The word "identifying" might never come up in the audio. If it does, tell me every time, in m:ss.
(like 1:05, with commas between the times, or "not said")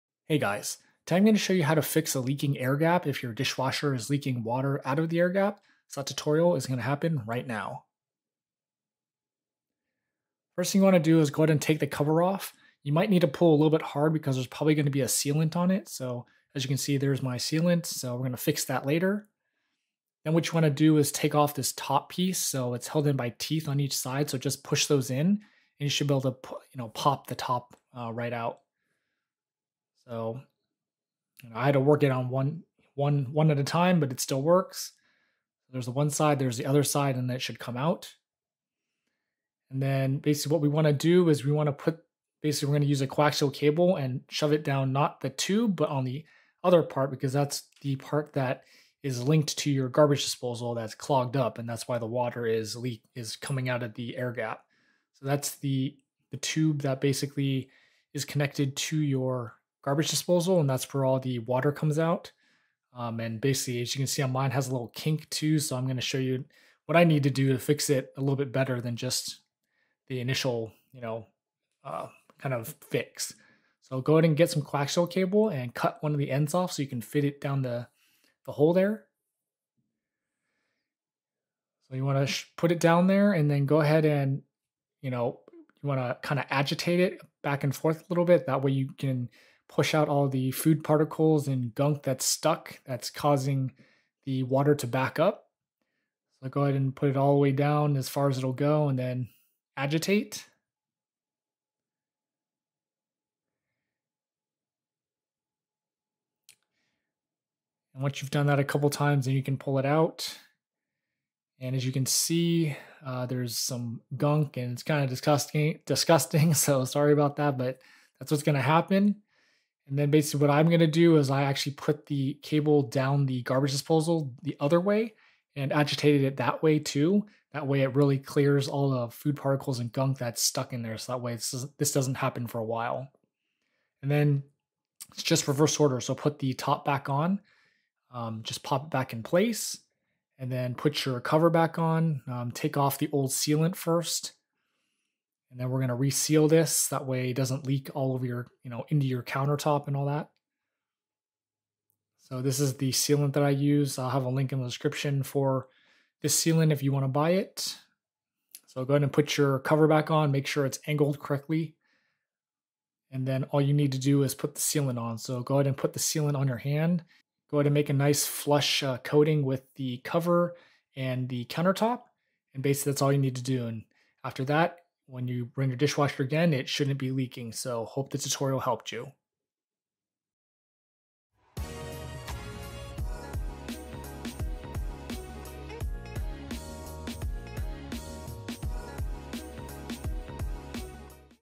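not said.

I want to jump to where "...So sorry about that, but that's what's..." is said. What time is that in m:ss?
1:56.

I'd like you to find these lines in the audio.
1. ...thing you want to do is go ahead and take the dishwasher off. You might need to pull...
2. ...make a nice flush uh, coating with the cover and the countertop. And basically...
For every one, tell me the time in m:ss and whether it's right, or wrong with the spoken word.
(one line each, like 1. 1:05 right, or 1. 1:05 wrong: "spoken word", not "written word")
1. 0:10 wrong: "cover", not "dishwasher"
2. 2:47 right.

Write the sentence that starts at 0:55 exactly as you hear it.
So that's the the tube that basically is connected to your garbage disposal, and that's where all the water comes out.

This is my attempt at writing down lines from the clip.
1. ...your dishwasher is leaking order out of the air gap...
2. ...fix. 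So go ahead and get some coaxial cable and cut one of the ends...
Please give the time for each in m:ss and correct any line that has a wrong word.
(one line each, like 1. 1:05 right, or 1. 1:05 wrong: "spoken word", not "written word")
1. 0:03 wrong: "water", not "order"
2. 1:12 right.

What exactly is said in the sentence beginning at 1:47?
And once you've done that a couple times, then you can pull it out.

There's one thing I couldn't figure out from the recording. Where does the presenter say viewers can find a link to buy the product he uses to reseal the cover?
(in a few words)
in the description.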